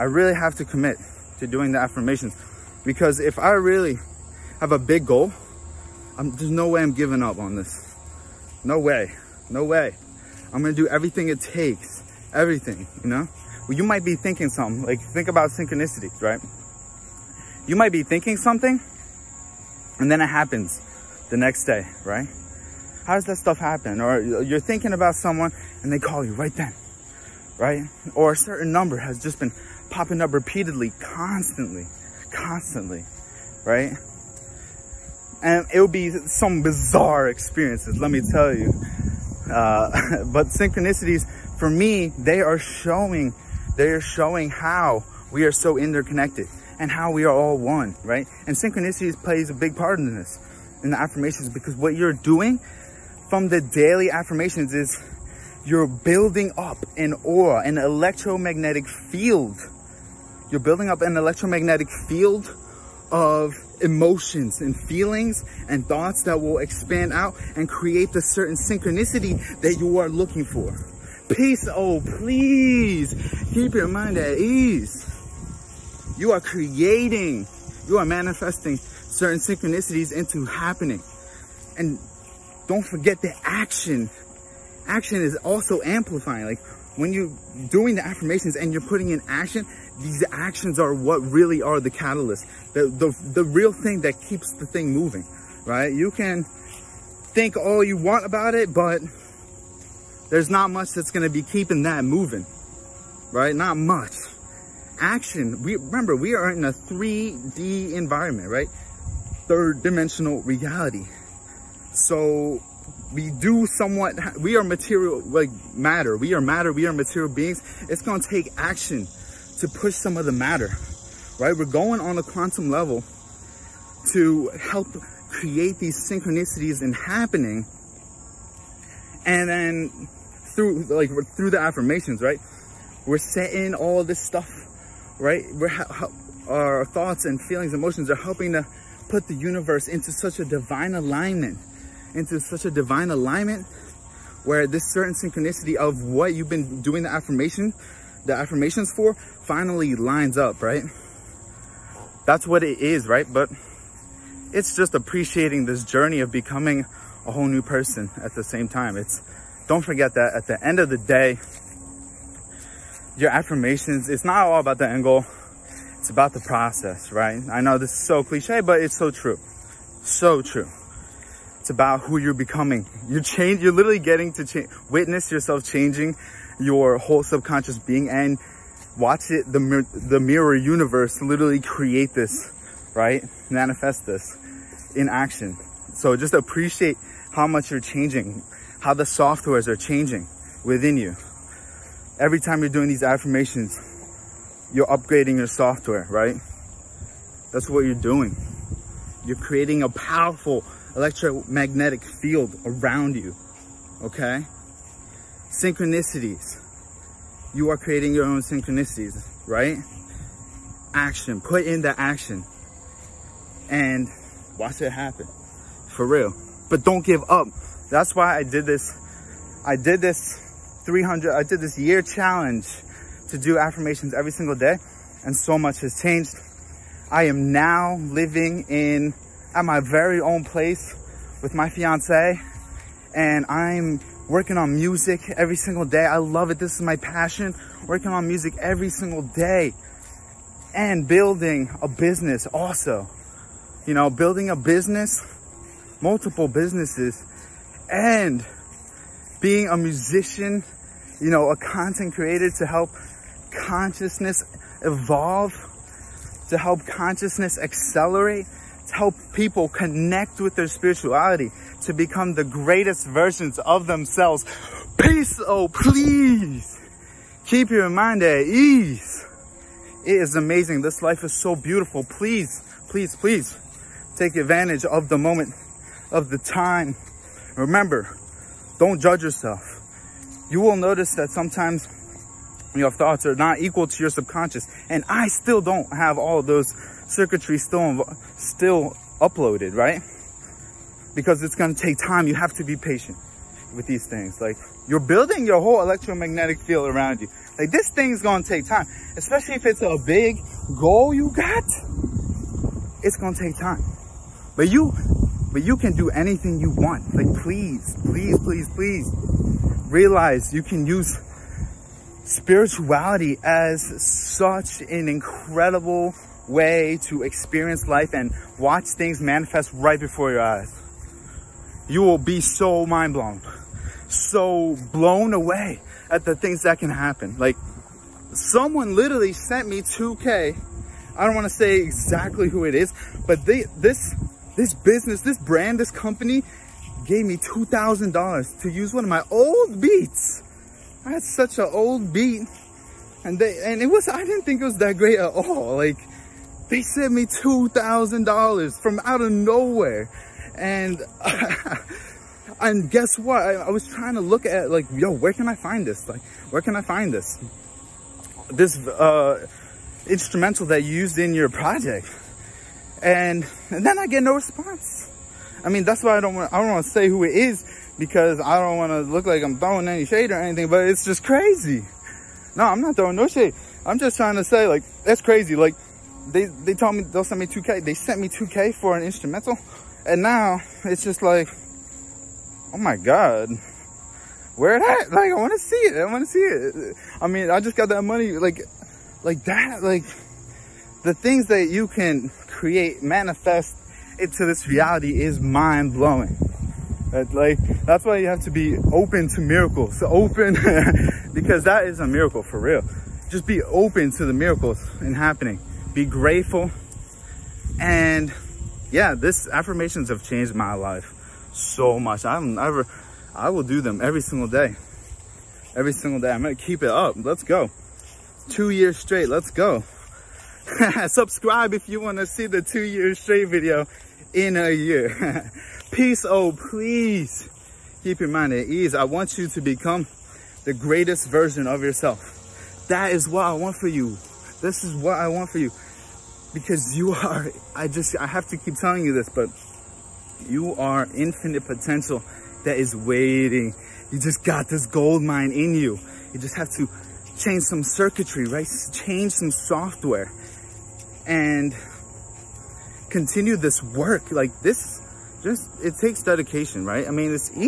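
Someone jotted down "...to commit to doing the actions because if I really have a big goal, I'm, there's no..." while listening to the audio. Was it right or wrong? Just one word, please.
wrong.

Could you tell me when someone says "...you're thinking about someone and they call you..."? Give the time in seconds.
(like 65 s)
24 s.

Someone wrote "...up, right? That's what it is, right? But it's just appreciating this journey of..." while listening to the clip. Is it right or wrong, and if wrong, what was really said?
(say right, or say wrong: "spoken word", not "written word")
right.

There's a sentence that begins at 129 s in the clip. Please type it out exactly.
And then through like through the affirmations, right?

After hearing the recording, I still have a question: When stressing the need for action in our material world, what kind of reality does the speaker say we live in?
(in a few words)
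third dimensional reality.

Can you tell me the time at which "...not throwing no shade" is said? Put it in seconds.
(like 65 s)
372 s.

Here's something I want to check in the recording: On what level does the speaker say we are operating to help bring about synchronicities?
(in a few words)
quantum level.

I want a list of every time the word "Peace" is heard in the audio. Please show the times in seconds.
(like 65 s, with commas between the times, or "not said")
71 s, 264 s, 425 s.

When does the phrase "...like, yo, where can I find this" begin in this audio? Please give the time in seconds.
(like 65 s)
354 s.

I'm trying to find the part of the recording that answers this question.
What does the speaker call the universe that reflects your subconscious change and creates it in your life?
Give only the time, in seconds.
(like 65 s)
180 s.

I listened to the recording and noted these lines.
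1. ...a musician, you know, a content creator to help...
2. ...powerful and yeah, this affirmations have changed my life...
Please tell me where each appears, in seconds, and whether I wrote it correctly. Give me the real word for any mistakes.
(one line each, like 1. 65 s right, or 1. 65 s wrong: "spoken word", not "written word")
1. 249 s right
2. 406 s wrong: "grateful", not "powerful".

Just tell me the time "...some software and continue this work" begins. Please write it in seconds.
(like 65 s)
449 s.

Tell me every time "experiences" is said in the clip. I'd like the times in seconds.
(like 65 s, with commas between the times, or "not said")
37 s, 317 s.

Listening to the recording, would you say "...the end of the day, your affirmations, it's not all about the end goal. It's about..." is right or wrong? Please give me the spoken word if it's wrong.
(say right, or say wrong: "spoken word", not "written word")
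right.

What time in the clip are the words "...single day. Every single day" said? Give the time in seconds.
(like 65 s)
414 s.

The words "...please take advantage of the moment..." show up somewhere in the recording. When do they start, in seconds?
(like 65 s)
273 s.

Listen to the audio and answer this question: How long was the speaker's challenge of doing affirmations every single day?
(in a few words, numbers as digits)
a year.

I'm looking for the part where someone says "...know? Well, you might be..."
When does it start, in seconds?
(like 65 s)
13 s.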